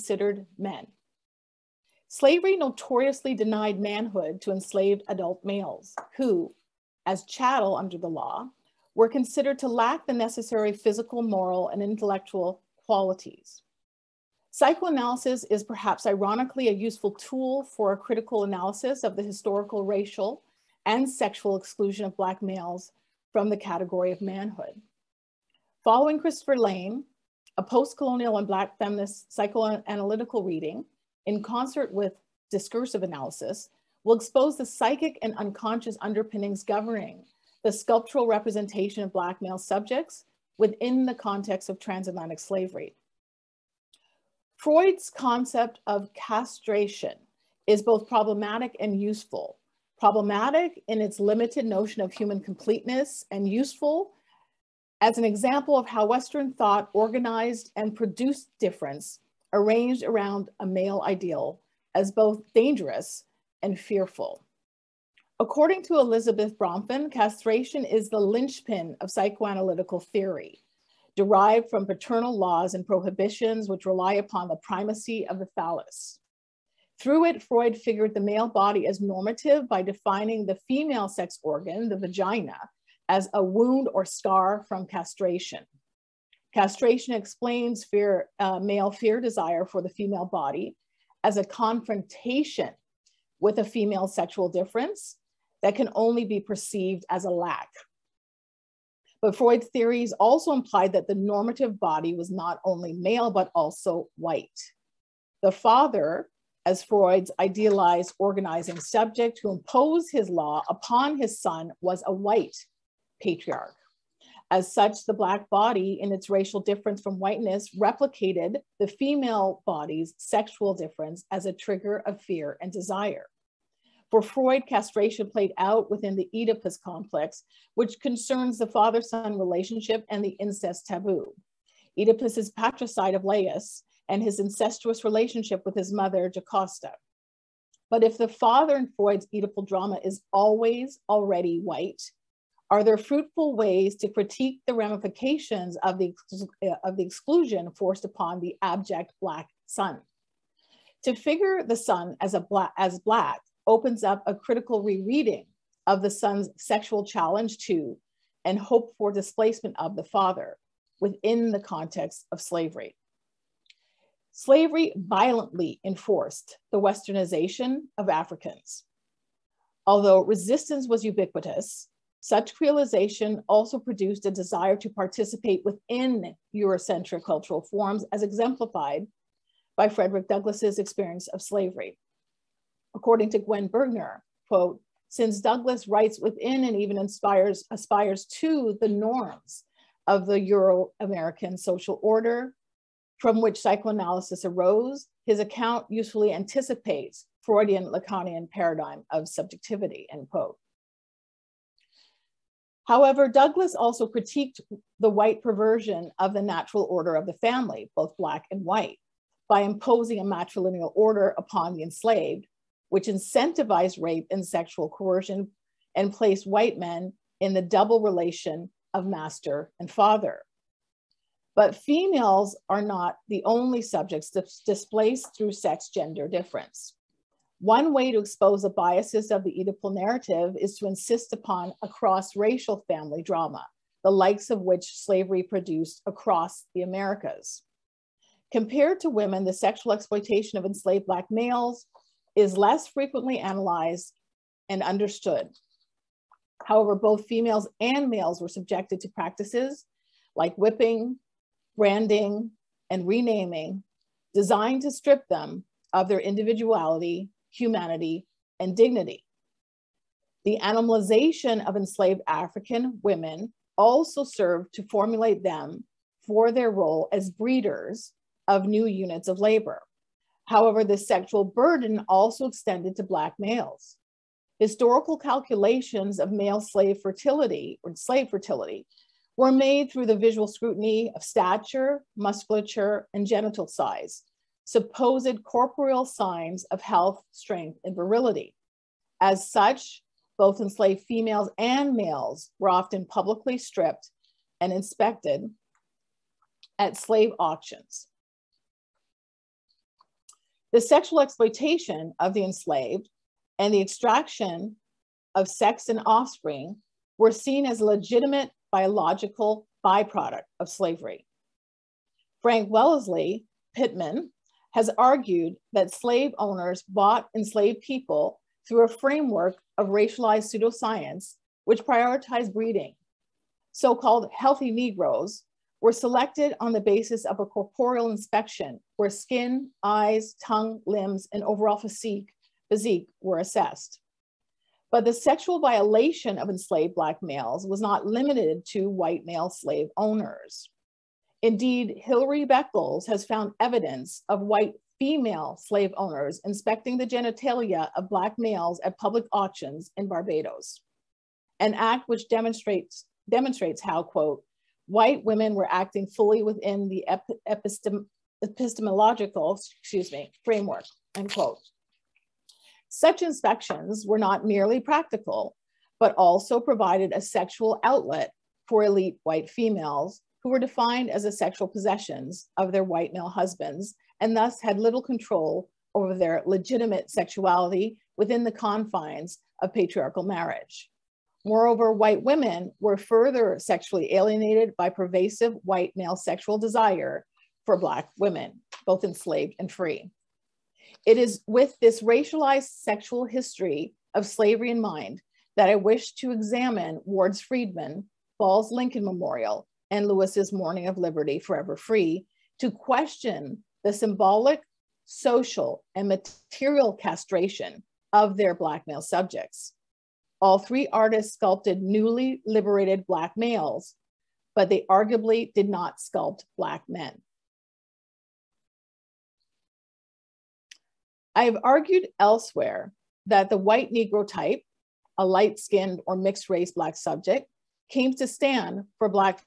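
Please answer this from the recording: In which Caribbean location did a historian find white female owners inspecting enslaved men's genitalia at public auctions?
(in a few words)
Barbados.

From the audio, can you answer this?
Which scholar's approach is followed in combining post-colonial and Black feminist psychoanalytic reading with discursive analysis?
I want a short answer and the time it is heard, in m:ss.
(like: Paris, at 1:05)
Christopher Lane, at 0:26.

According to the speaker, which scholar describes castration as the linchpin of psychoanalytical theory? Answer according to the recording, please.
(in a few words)
Elizabeth Bronfen.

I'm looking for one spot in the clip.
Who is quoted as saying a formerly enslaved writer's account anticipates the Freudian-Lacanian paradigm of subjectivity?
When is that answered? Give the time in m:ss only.
3:03.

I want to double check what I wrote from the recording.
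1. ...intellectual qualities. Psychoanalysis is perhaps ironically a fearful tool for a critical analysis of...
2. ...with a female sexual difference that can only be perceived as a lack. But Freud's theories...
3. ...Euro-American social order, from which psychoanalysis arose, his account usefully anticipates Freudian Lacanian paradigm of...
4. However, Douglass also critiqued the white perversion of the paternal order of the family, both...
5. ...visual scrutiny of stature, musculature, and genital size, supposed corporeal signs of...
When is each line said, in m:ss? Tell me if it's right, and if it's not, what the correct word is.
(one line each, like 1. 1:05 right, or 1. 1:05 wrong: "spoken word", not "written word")
1. 0:11 wrong: "useful", not "fearful"
2. 1:33 right
3. 3:10 right
4. 3:22 wrong: "natural", not "paternal"
5. 4:40 right.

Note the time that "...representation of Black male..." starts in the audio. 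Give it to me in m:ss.
0:38.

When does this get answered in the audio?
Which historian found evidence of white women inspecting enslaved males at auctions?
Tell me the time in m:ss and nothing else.
5:41.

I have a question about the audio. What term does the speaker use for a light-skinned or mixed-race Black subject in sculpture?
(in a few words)
white Negro type.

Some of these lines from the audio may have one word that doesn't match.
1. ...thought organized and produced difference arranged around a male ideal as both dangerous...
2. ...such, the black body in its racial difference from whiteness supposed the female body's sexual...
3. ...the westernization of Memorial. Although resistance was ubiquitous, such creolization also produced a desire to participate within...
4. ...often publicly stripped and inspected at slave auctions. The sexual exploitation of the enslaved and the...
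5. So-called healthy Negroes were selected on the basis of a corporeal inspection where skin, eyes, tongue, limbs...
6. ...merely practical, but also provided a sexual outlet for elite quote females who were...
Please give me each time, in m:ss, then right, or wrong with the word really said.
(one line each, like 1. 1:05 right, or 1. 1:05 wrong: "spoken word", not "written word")
1. 0:56 right
2. 1:54 wrong: "replicated", not "supposed"
3. 2:46 wrong: "Africans", not "Memorial"
4. 4:52 right
5. 5:23 right
6. 6:04 wrong: "white", not "quote".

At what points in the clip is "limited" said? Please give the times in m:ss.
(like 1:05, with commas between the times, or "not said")
0:51, 5:38.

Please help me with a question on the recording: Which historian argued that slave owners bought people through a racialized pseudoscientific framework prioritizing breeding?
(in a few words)
Frank Wellesley Pitman.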